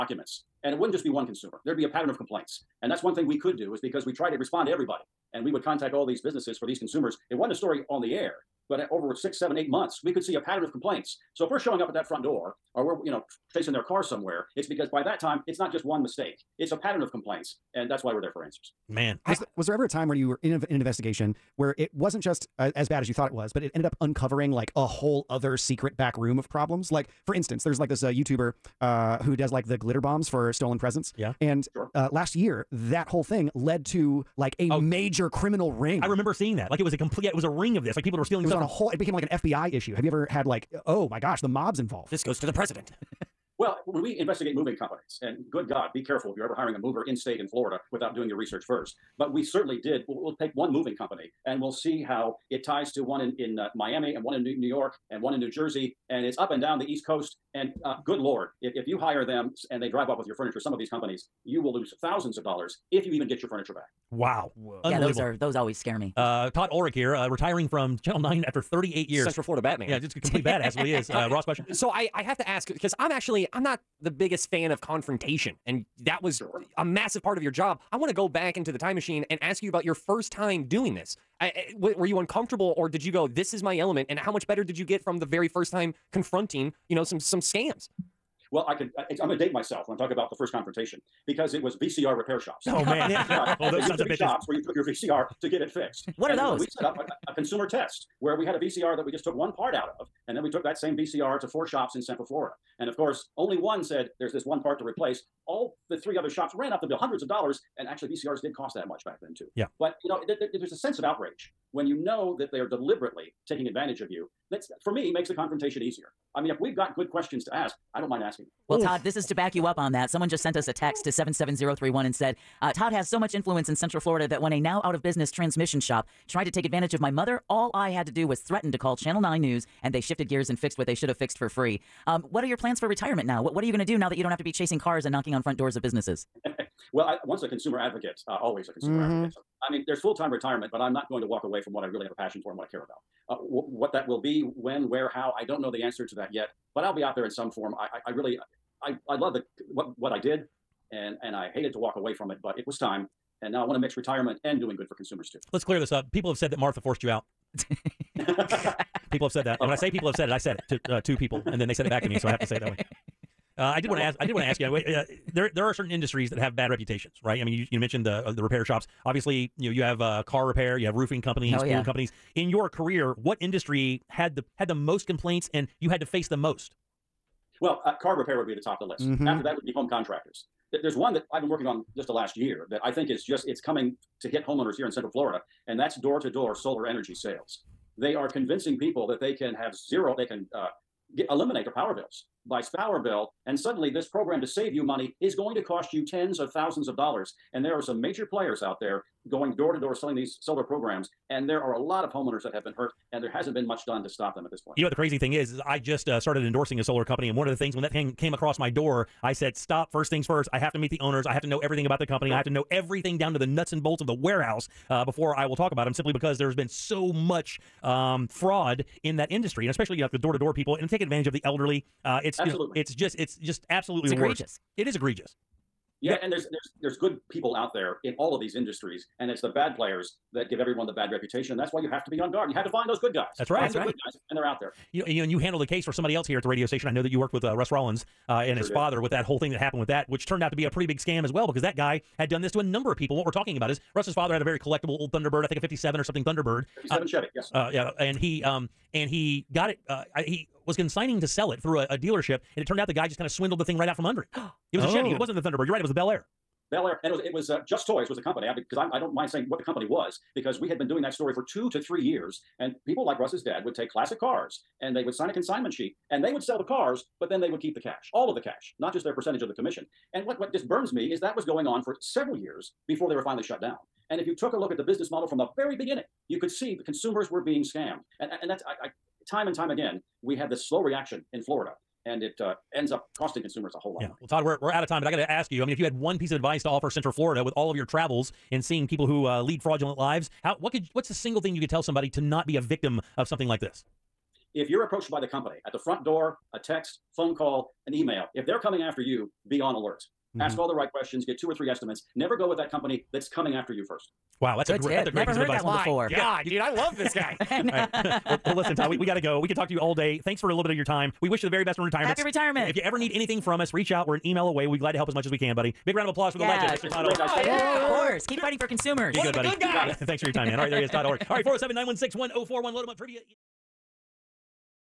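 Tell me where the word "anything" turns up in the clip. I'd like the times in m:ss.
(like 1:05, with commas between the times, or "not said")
5:13.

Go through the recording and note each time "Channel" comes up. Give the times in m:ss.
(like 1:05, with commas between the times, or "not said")
1:08, 2:08.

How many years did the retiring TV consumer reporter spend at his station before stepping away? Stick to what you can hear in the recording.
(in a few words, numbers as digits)
38.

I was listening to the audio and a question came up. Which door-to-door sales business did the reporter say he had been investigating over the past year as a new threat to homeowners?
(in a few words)
Solar energy sales.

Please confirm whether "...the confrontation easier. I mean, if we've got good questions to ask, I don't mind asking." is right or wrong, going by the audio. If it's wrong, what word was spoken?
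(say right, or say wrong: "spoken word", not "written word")
right.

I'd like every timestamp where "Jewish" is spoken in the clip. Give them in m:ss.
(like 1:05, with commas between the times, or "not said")
not said.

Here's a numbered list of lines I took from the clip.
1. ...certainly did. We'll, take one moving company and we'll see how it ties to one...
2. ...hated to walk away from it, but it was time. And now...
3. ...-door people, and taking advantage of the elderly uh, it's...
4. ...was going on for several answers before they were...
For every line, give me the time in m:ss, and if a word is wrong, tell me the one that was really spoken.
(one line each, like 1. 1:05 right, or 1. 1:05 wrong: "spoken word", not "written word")
1. 0:49 right
2. 2:31 right
3. 3:40 right
4. 4:31 wrong: "years", not "answers".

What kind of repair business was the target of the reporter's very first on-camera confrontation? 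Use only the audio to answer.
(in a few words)
VCR repair shops.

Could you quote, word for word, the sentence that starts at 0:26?
Like, for instance, there's like this uh, YouTuber uh, who does like the glitter bombs for stolen presents.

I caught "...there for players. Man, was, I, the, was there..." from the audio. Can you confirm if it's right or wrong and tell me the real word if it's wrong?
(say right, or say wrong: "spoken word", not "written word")
wrong: "answers", not "players".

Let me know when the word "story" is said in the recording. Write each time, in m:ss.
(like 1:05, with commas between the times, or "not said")
0:07, 4:21.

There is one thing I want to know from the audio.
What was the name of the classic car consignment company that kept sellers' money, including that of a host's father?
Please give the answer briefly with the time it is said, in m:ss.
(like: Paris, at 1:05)
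Just Toys, at 4:17.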